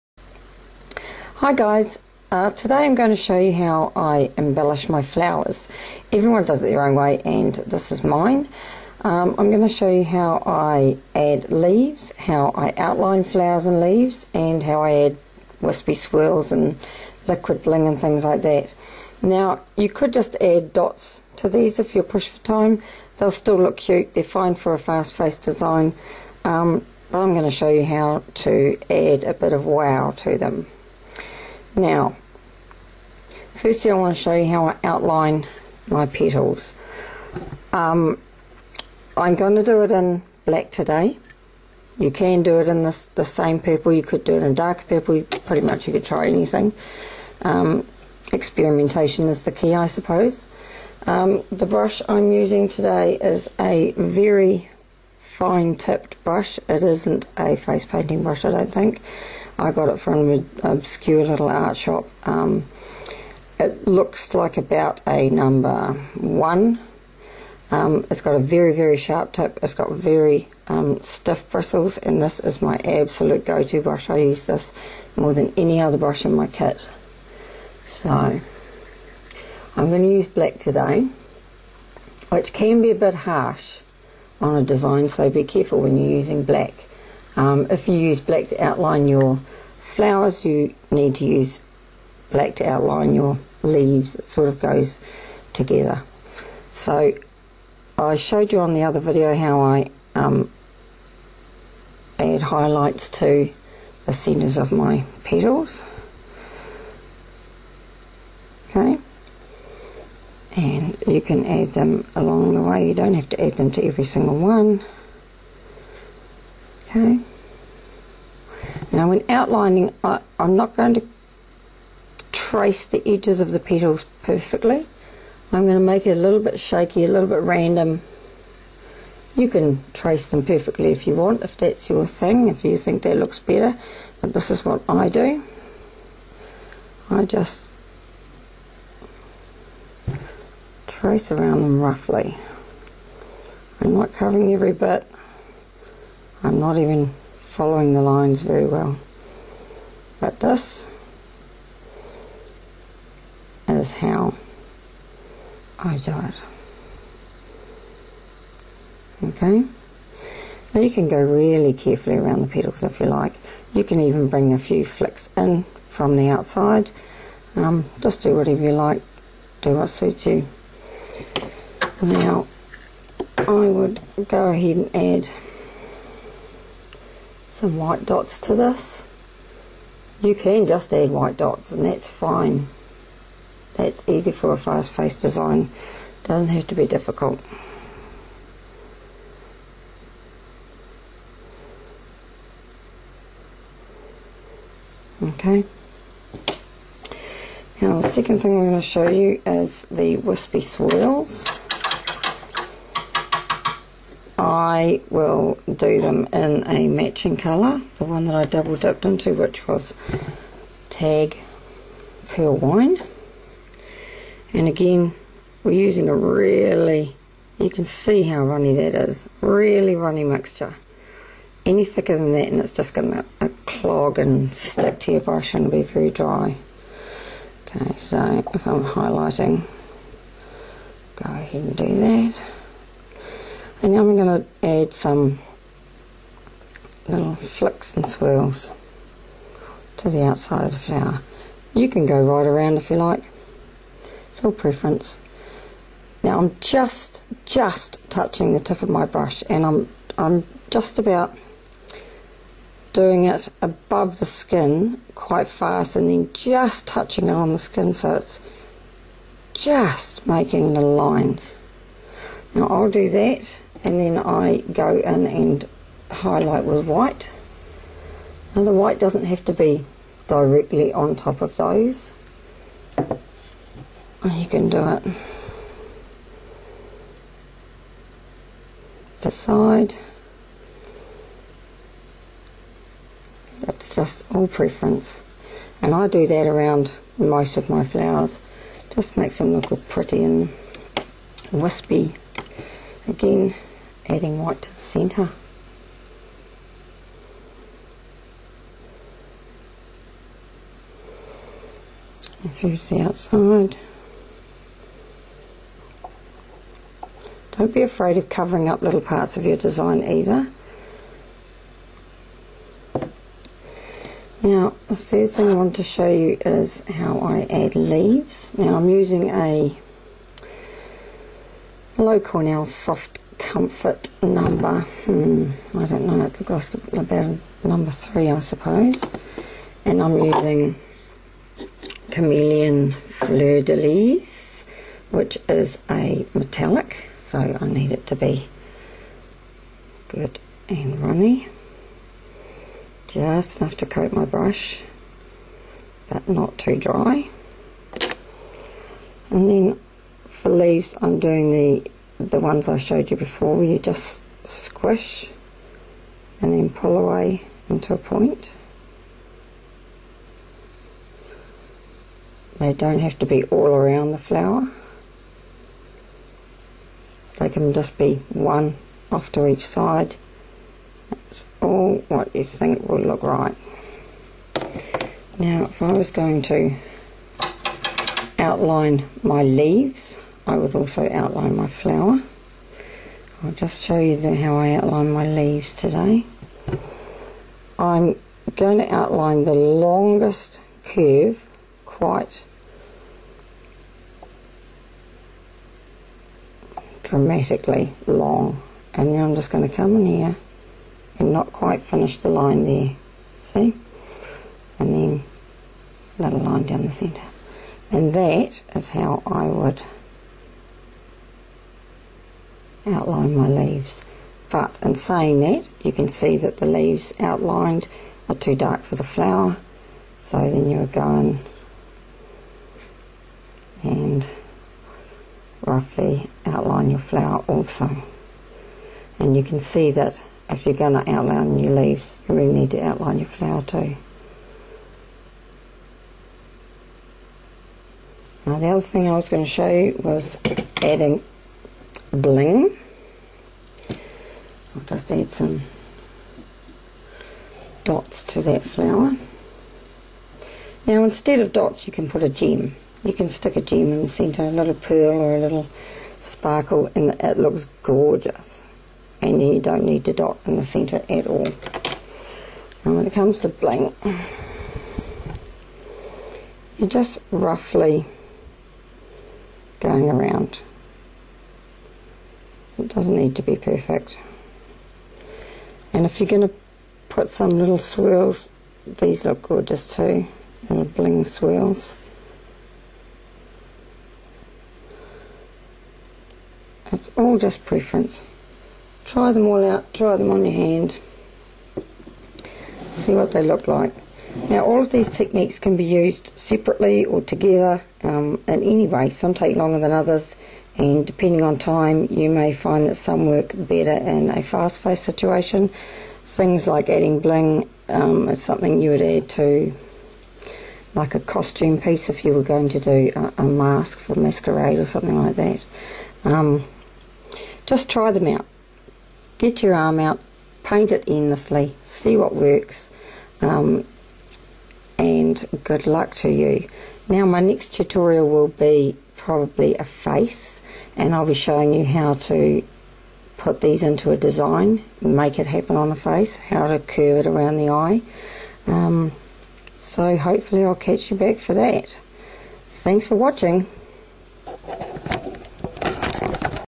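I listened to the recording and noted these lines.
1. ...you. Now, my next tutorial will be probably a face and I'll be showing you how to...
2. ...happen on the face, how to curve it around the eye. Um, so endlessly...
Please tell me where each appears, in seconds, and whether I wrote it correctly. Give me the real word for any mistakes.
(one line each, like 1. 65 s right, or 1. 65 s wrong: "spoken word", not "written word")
1. 526 s right
2. 535 s wrong: "hopefully", not "endlessly".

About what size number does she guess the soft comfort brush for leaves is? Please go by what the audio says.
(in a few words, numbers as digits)
3.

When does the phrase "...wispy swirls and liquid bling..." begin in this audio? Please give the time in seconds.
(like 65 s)
15 s.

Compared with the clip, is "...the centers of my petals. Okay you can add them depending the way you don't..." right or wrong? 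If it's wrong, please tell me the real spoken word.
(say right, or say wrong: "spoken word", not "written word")
wrong: "along", not "depending".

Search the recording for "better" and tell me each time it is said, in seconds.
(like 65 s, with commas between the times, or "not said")
133 s, 503 s.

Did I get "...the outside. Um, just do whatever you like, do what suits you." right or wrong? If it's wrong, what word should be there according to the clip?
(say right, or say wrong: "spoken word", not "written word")
right.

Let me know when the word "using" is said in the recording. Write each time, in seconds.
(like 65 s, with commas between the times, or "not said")
52 s, 86 s, 215 s, 318 s, 330 s.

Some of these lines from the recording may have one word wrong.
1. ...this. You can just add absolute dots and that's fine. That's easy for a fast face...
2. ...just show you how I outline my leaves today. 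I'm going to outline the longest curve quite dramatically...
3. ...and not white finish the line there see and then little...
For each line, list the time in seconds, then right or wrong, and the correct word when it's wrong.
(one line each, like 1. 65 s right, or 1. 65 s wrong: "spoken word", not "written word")
1. 178 s wrong: "white", not "absolute"
2. 383 s right
3. 401 s wrong: "quite", not "white".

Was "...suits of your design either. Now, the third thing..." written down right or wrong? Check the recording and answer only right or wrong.
wrong.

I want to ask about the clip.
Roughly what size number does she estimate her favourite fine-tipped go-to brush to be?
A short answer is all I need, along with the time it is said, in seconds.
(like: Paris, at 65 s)
1, at 64 s.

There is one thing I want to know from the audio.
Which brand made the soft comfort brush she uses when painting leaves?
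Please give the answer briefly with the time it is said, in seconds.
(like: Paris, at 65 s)
Loew-Cornell, at 321 s.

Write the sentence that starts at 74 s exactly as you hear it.
I use this more than any other brush in my kit.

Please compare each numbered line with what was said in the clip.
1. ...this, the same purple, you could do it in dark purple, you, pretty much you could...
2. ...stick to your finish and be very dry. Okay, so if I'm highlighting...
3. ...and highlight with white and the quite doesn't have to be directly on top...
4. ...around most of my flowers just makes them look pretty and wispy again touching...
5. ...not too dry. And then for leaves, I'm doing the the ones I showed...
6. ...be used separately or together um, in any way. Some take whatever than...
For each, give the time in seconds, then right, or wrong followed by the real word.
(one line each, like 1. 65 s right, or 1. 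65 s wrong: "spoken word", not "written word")
1. 42 s right
2. 224 s wrong: "brush", not "finish"
3. 265 s wrong: "white", not "quite"
4. 286 s wrong: "adding", not "touching"
5. 346 s right
6. 495 s wrong: "longer", not "whatever".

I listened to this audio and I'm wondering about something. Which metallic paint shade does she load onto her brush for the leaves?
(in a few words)
Chameleon Fleur de Lis.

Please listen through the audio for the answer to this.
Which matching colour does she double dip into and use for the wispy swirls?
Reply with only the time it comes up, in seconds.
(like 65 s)
210 s.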